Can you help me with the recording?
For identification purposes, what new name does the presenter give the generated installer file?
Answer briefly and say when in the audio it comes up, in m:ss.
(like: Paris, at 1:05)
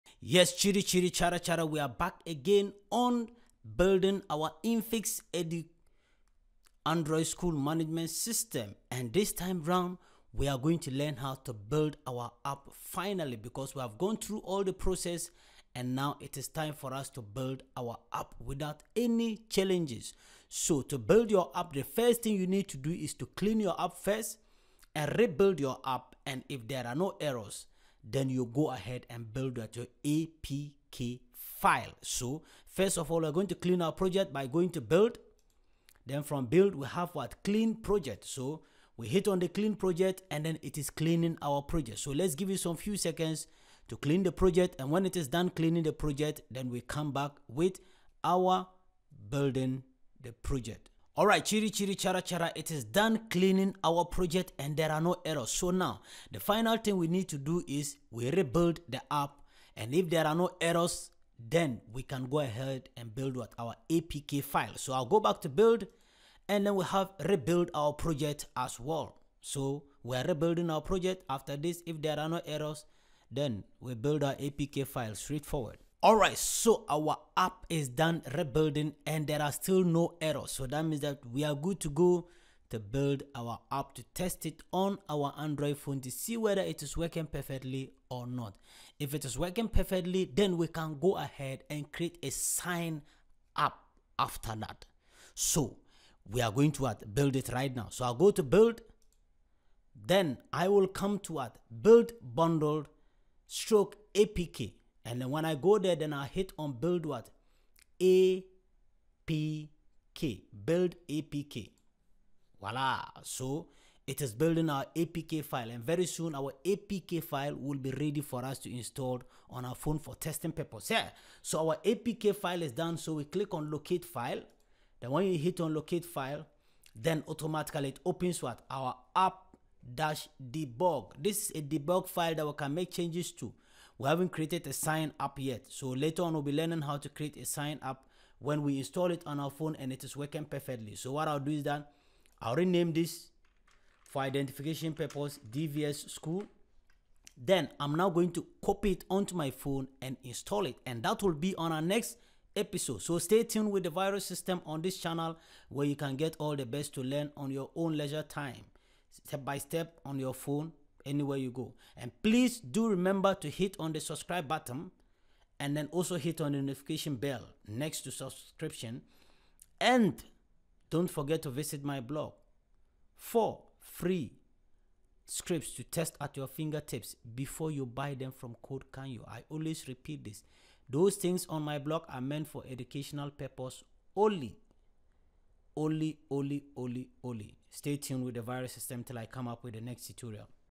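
DVS School, at 2:25.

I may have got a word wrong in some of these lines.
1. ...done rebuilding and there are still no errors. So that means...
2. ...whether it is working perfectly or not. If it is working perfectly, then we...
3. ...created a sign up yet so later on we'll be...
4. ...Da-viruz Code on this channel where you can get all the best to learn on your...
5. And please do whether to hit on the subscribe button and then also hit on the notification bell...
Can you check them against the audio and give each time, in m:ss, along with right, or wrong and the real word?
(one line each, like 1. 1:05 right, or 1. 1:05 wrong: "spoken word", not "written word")
1. 1:17 right
2. 1:26 right
3. 2:14 right
4. 2:33 wrong: "System", not "Code"
5. 2:41 wrong: "remember", not "whether".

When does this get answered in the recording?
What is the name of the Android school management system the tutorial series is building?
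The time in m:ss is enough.
0:04.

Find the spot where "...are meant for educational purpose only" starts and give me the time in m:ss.
3:02.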